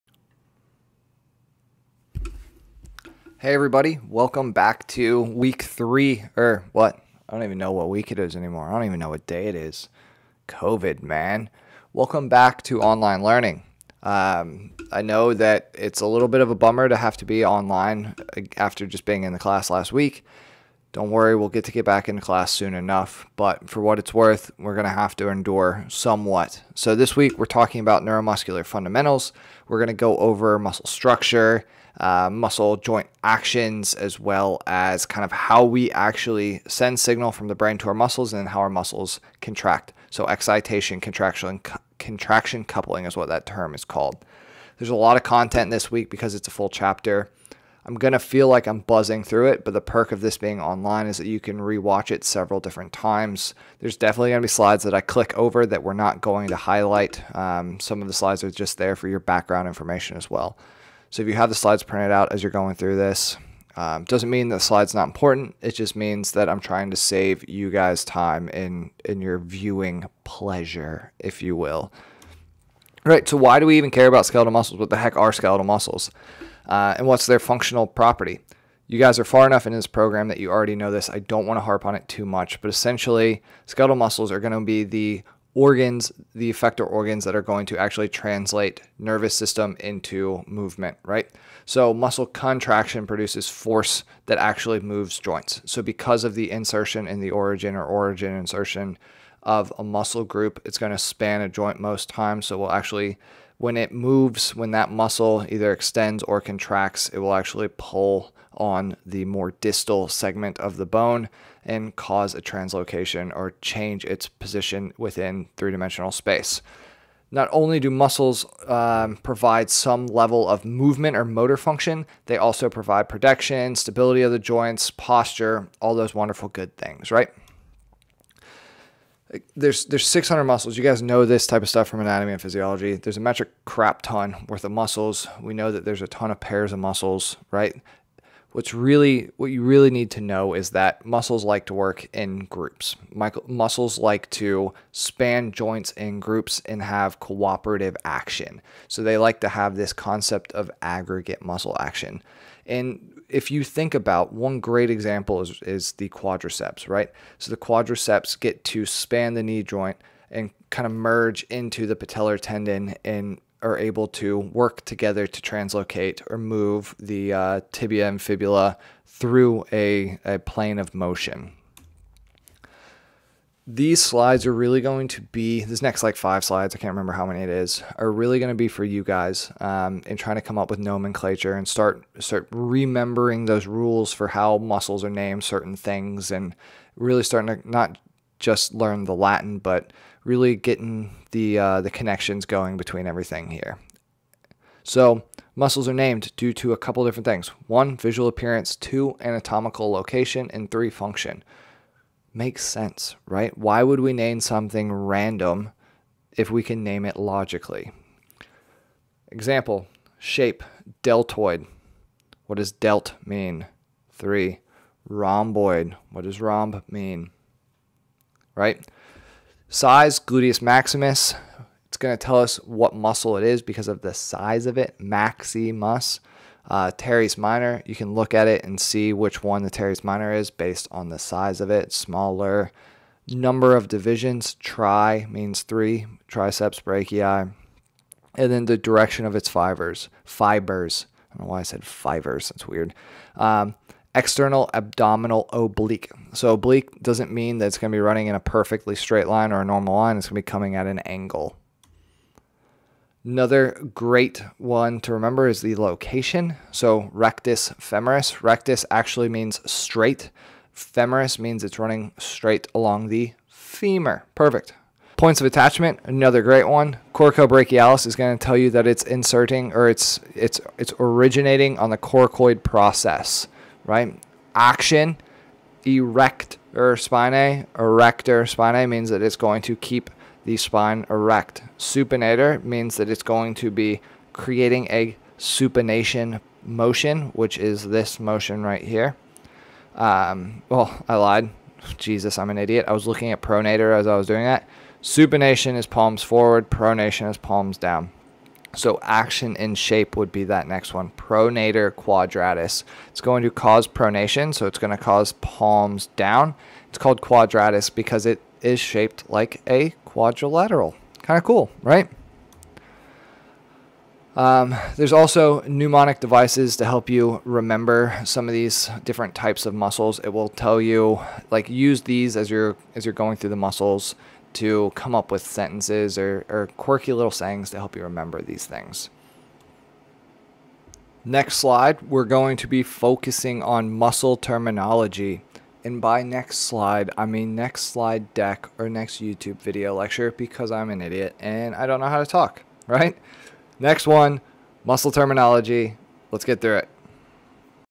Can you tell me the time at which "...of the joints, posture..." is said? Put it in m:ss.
2:04.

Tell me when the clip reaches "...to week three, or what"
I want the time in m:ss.
0:04.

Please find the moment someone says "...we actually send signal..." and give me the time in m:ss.
0:35.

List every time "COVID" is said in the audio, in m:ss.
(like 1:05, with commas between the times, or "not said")
0:10.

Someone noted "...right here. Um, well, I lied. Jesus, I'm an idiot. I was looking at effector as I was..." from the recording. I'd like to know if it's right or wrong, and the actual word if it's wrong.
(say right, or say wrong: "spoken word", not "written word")
wrong: "pronator", not "effector".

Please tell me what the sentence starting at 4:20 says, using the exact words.
Femoris means it's running straight along the femur.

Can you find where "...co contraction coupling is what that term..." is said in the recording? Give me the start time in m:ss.
0:41.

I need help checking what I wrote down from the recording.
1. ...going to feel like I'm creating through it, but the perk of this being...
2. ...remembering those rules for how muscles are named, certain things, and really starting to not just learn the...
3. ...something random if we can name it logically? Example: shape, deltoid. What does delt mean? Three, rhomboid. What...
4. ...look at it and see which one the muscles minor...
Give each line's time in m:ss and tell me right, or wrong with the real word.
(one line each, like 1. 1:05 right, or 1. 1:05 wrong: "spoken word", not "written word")
1. 0:47 wrong: "buzzing", not "creating"
2. 3:02 right
3. 3:24 right
4. 3:48 wrong: "teres", not "muscles".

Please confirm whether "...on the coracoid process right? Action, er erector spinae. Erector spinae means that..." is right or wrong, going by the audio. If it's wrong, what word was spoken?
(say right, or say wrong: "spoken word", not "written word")
right.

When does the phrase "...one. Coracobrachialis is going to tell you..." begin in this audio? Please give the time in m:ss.
4:26.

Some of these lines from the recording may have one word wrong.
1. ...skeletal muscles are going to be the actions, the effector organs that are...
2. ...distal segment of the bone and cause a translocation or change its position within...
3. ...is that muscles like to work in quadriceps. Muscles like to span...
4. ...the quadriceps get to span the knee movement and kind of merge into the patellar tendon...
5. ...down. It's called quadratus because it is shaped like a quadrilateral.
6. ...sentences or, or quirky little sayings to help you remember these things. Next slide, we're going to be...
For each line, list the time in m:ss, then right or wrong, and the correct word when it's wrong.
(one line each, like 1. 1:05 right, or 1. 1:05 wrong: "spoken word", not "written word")
1. 1:23 wrong: "organs", not "actions"
2. 1:49 right
3. 2:20 wrong: "groups", not "quadriceps"
4. 2:37 wrong: "joint", not "movement"
5. 5:06 right
6. 5:25 right.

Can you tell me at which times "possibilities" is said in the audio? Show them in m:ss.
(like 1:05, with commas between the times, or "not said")
not said.